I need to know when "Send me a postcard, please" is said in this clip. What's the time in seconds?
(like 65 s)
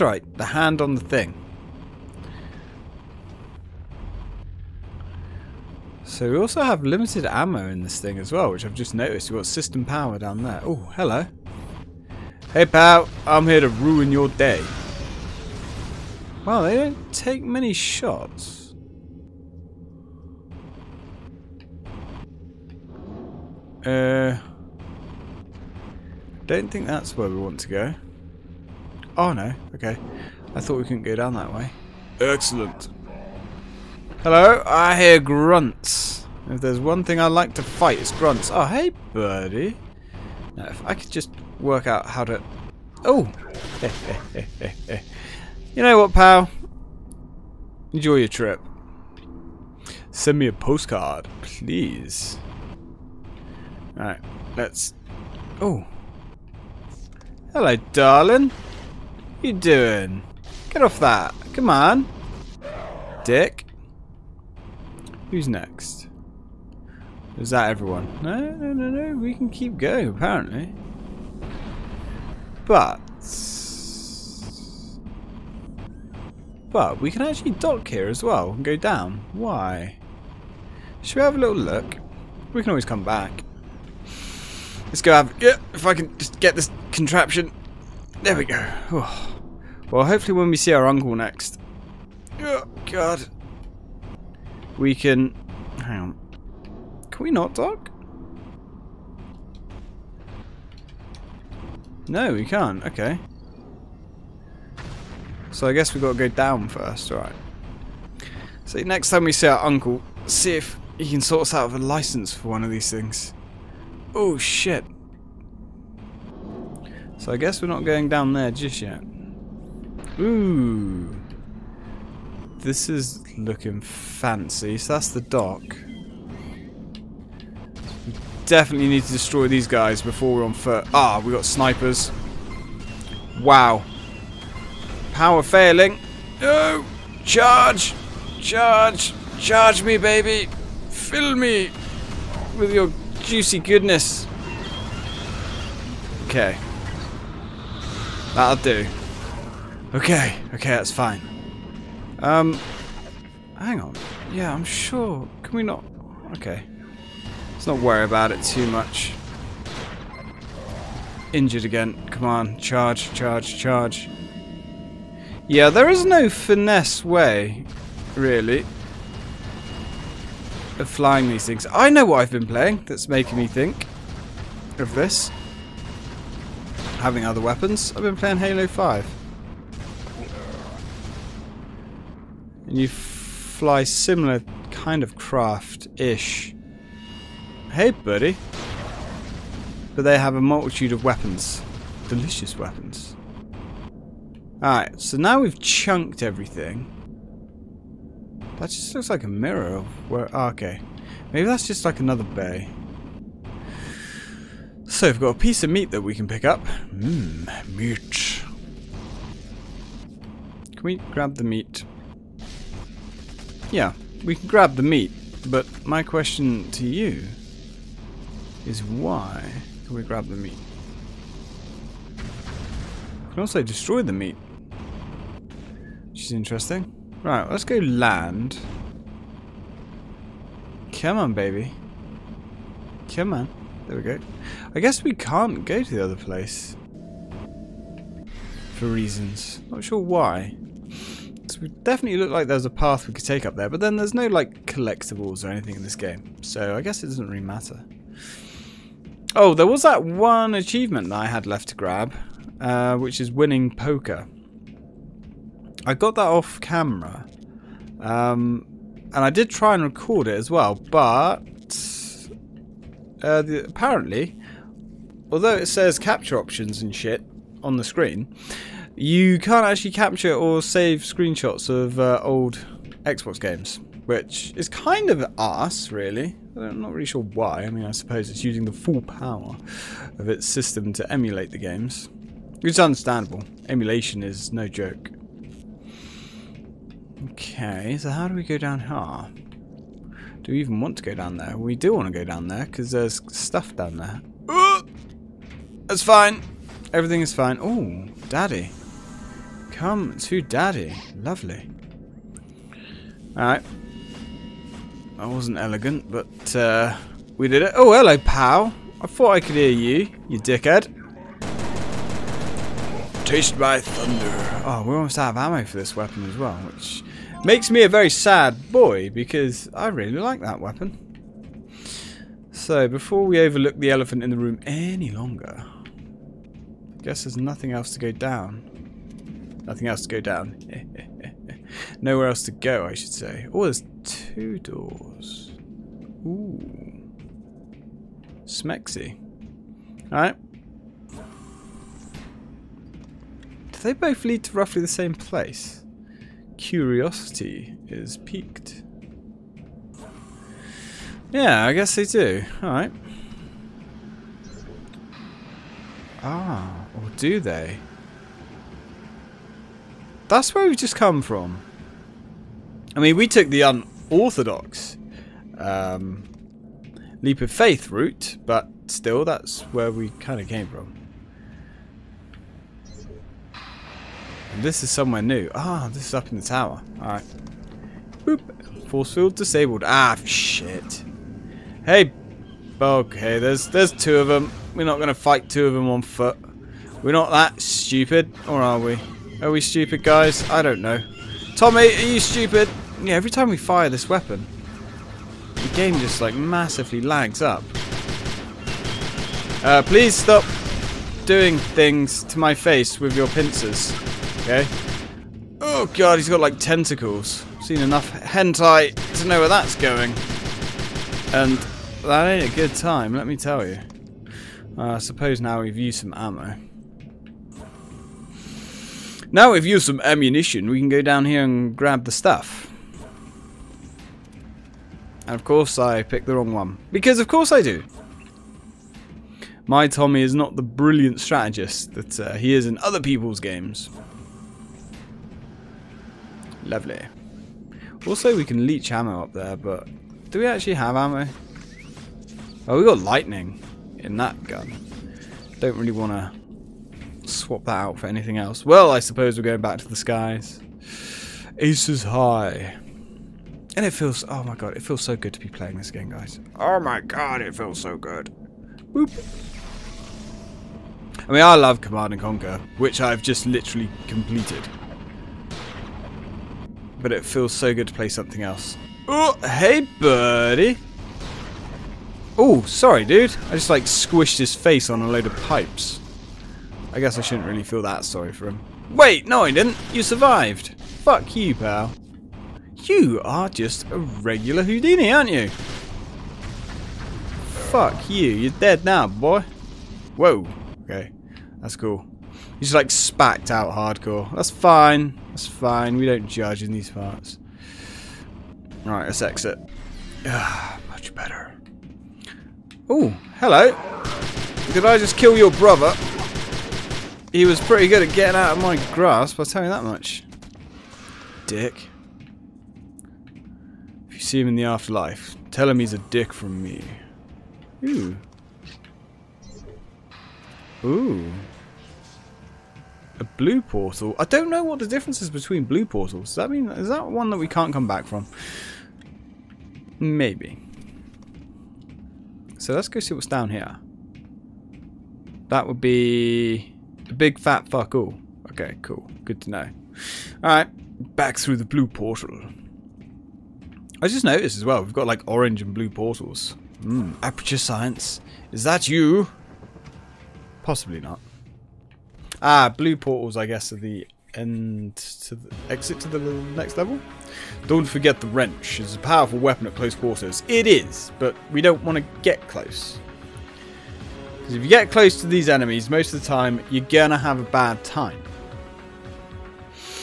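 50 s.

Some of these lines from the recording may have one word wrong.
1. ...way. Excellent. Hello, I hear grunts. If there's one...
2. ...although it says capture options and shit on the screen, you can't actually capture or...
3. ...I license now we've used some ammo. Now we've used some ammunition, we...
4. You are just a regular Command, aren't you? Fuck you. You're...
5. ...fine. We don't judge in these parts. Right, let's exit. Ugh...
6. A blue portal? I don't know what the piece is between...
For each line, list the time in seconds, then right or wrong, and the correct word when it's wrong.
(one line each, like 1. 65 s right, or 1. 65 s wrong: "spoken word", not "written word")
1. 31 s right
2. 265 s right
3. 414 s wrong: "suppose", not "license"
4. 482 s wrong: "Houdini", not "Command"
5. 495 s right
6. 523 s wrong: "difference", not "piece".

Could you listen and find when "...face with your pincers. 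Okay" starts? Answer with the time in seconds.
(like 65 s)
402 s.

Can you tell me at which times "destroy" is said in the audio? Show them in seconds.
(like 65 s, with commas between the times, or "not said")
129 s, 223 s.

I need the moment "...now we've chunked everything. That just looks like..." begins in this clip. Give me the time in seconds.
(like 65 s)
195 s.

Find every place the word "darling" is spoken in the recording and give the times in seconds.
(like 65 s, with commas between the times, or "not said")
57 s.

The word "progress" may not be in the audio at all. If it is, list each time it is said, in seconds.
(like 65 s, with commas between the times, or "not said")
not said.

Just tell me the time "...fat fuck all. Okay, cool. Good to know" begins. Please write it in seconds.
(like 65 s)
537 s.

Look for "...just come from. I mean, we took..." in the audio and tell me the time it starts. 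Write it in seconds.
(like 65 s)
360 s.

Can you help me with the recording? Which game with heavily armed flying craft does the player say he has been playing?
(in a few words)
Halo 5.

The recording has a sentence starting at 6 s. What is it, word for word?
So we also have limited ammo in this thing as well, which I've just noticed.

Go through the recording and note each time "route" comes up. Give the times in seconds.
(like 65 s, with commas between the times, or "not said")
367 s.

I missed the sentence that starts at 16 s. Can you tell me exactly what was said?
Well, they don't take many shots.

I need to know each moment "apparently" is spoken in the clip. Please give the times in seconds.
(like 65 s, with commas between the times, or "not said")
70 s, 263 s.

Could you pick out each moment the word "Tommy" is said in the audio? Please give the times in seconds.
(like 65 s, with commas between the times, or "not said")
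391 s, 429 s.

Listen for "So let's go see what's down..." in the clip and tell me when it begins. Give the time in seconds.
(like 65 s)
532 s.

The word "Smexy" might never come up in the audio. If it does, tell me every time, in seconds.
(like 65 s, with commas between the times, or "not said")
338 s.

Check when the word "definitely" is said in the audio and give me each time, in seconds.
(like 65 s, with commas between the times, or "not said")
128 s, 241 s.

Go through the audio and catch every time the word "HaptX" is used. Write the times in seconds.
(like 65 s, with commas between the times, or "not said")
not said.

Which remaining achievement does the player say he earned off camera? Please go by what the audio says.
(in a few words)
winning poker.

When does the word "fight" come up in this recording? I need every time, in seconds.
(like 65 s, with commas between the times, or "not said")
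37 s, 385 s.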